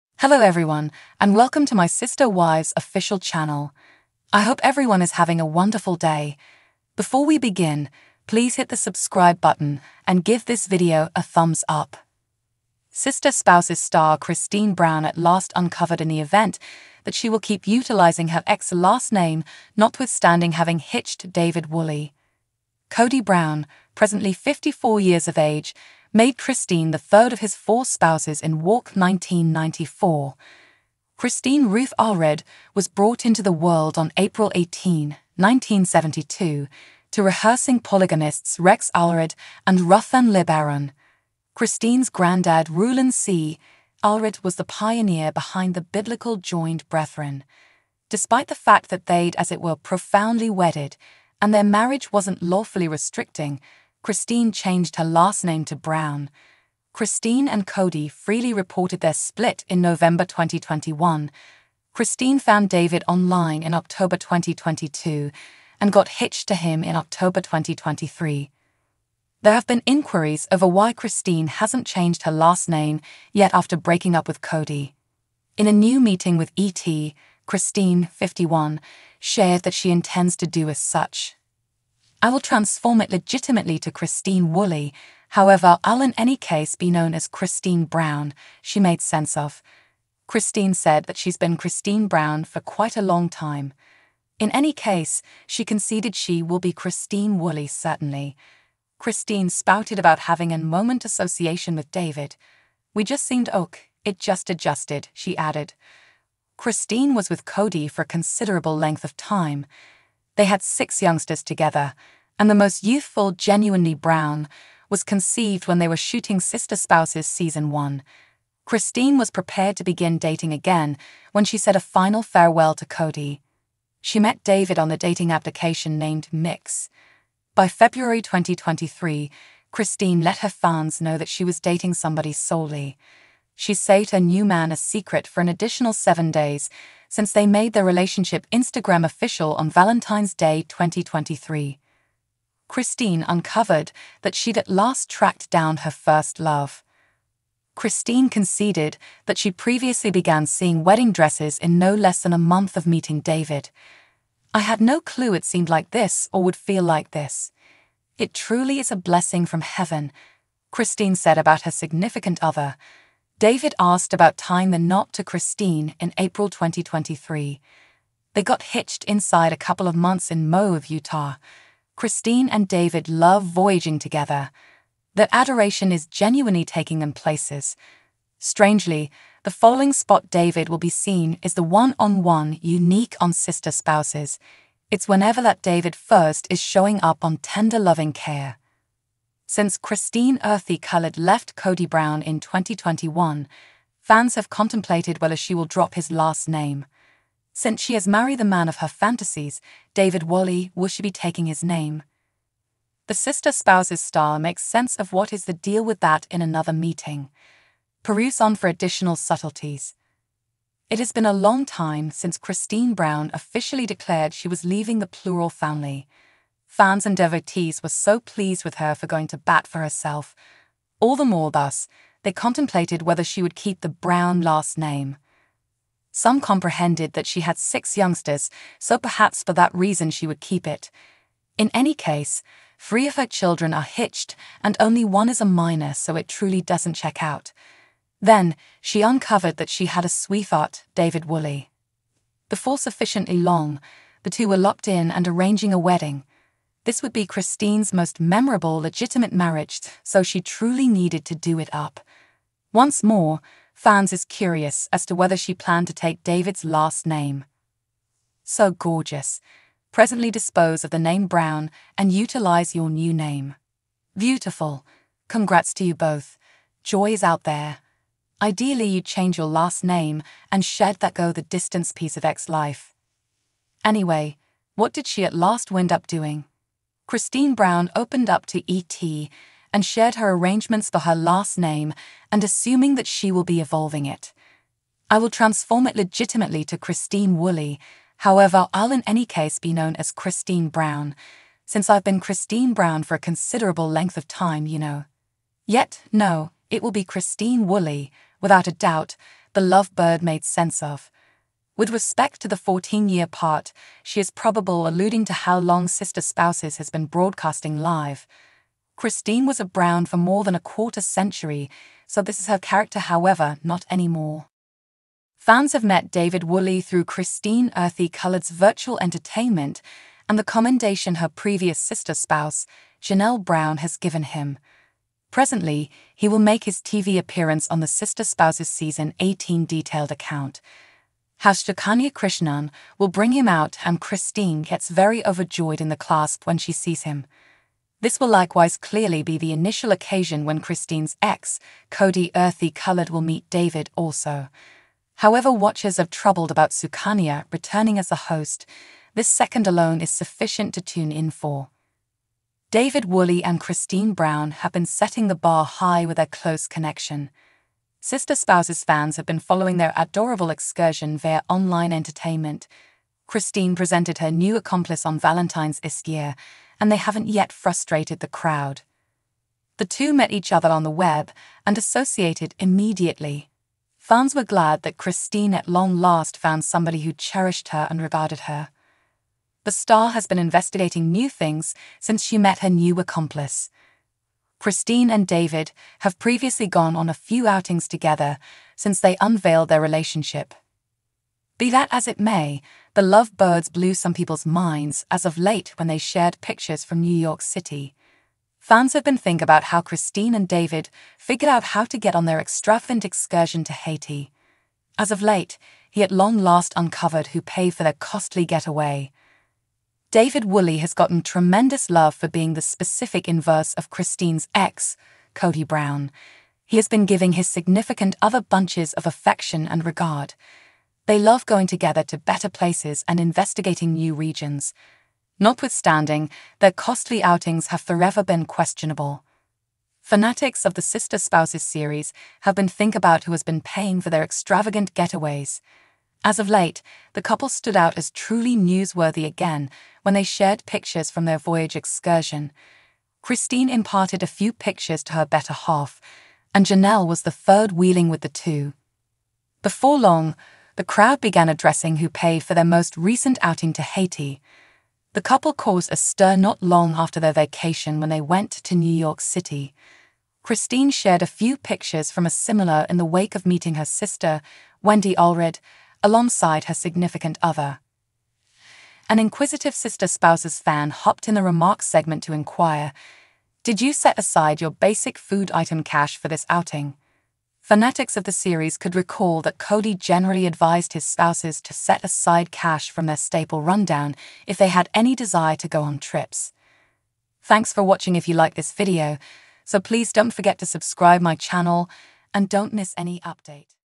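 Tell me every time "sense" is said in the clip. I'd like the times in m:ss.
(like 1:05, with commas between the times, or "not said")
1:29, 3:24, 5:00.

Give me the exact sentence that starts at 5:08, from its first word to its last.
Christine was a Brown for more than a quarter century, so this is her character, however, not anymore.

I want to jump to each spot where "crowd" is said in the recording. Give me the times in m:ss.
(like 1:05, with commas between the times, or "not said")
6:08, 7:30.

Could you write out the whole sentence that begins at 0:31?
Christine Ruth Allred was brought into the world on April 18, 1972, to rehearsing polygamists Rex Allred and Ruthan LeBaron.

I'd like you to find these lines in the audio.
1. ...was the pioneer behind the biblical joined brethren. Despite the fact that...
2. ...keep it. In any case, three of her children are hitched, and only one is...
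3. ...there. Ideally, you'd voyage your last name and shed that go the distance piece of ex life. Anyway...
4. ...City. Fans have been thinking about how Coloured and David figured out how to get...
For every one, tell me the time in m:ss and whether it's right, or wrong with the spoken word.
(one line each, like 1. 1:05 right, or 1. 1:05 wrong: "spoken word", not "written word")
1. 0:44 right
2. 3:50 right
3. 4:27 wrong: "change", not "voyage"
4. 6:37 wrong: "Christine", not "Coloured".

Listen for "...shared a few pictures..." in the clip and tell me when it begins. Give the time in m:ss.
7:40.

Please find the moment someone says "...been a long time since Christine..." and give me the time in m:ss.
3:31.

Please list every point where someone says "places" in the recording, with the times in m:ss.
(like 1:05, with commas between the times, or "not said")
2:57, 7:02.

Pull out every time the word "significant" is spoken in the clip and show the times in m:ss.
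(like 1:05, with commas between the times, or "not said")
2:41, 6:57, 7:46.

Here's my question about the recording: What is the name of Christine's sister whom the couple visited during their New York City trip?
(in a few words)
Wendy Ulrich.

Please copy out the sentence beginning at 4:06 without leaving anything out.
This would be Christine's most memorable legitimate marriage, so she truly needed to do it up.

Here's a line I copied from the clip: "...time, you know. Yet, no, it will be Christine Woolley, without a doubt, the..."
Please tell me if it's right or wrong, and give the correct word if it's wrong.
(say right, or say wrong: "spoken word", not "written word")
right.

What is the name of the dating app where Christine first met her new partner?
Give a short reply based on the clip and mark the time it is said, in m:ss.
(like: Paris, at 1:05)
Mix, at 2:06.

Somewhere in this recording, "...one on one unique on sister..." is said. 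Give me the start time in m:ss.
3:01.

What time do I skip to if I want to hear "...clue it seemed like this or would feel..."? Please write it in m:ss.
2:35.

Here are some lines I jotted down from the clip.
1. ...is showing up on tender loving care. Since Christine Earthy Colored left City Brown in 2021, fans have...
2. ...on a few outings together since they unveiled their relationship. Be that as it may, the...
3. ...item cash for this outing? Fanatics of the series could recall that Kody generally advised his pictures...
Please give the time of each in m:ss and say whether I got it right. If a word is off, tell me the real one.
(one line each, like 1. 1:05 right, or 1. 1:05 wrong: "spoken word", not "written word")
1. 3:06 wrong: "Kody", not "City"
2. 6:26 right
3. 7:55 wrong: "spouses", not "pictures".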